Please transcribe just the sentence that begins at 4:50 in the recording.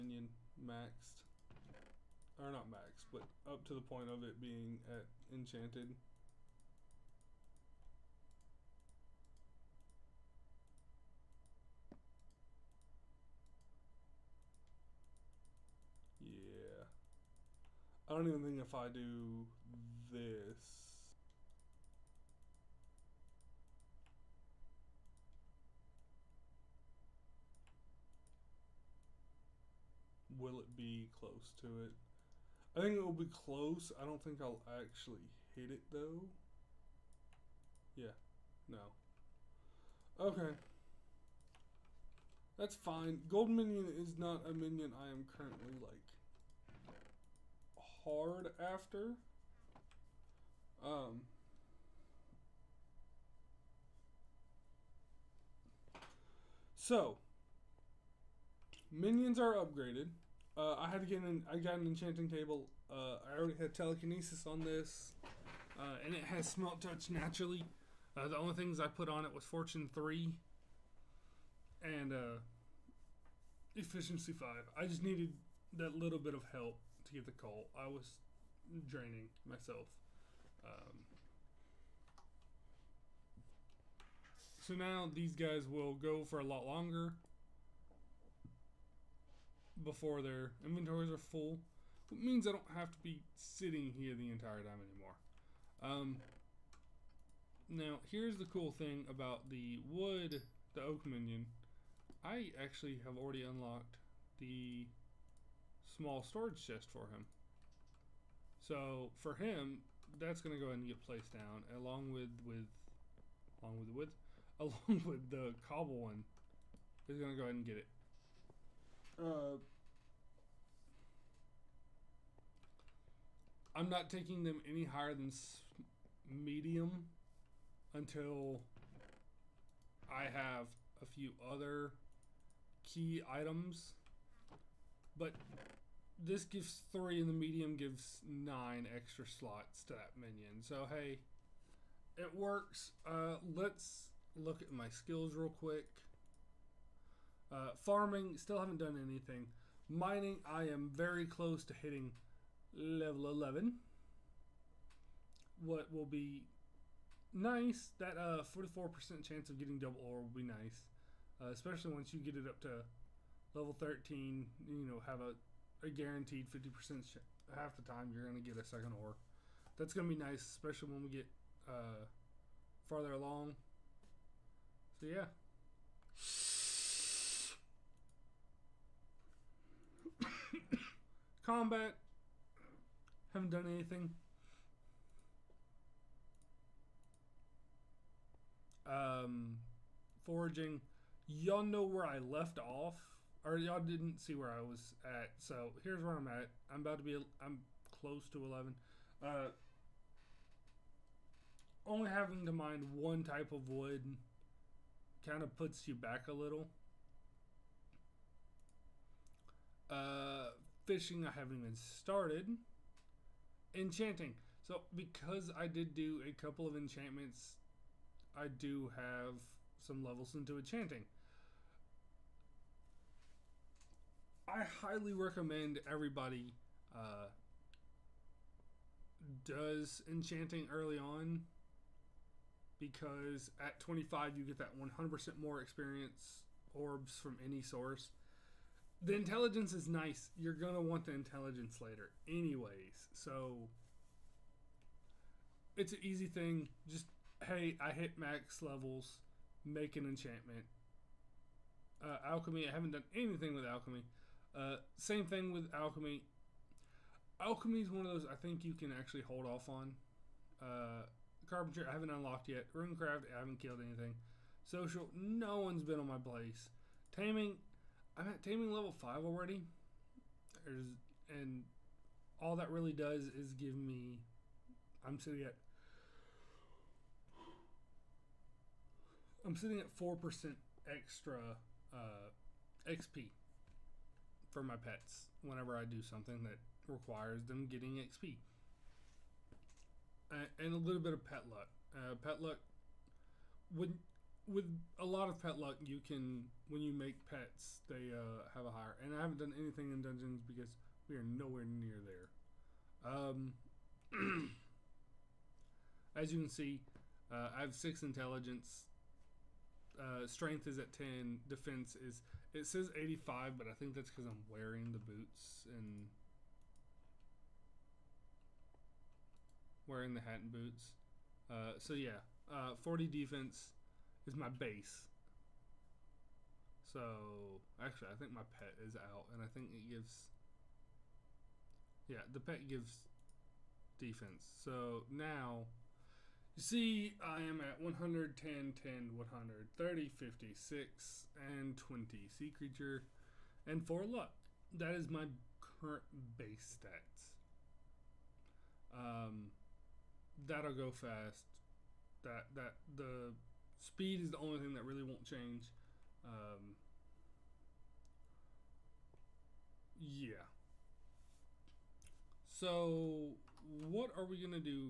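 and a little bit of pet luck.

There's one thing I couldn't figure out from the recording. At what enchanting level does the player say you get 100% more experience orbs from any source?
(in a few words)
25.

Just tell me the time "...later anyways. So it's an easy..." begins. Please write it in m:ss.
4:01.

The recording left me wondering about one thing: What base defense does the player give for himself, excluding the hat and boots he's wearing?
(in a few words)
40.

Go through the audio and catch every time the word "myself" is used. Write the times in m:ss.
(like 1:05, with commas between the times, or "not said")
1:19.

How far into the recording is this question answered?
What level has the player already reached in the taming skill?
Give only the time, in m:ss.
4:28.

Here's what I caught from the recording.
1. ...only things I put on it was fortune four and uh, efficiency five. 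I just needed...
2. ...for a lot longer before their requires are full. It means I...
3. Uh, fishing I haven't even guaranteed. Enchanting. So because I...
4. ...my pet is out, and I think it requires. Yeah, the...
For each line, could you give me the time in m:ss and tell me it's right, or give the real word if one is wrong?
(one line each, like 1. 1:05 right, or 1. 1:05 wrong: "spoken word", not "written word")
1. 1:08 wrong: "three", not "four"
2. 1:26 wrong: "inventories", not "requires"
3. 3:29 wrong: "started", not "guaranteed"
4. 5:28 wrong: "gives", not "requires".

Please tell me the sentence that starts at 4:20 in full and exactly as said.
Uh, Carpenter, I haven't unlocked yet.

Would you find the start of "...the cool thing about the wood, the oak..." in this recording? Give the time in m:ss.
1:38.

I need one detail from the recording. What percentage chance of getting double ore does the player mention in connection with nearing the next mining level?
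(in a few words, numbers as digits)
44%.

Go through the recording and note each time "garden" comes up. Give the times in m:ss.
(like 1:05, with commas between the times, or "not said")
not said.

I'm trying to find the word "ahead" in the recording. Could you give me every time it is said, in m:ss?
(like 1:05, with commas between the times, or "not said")
1:50, 1:57.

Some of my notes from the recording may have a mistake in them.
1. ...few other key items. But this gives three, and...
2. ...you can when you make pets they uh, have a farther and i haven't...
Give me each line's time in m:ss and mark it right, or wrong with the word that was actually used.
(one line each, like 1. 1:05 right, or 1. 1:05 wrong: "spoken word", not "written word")
1. 2:11 right
2. 4:55 wrong: "higher", not "farther".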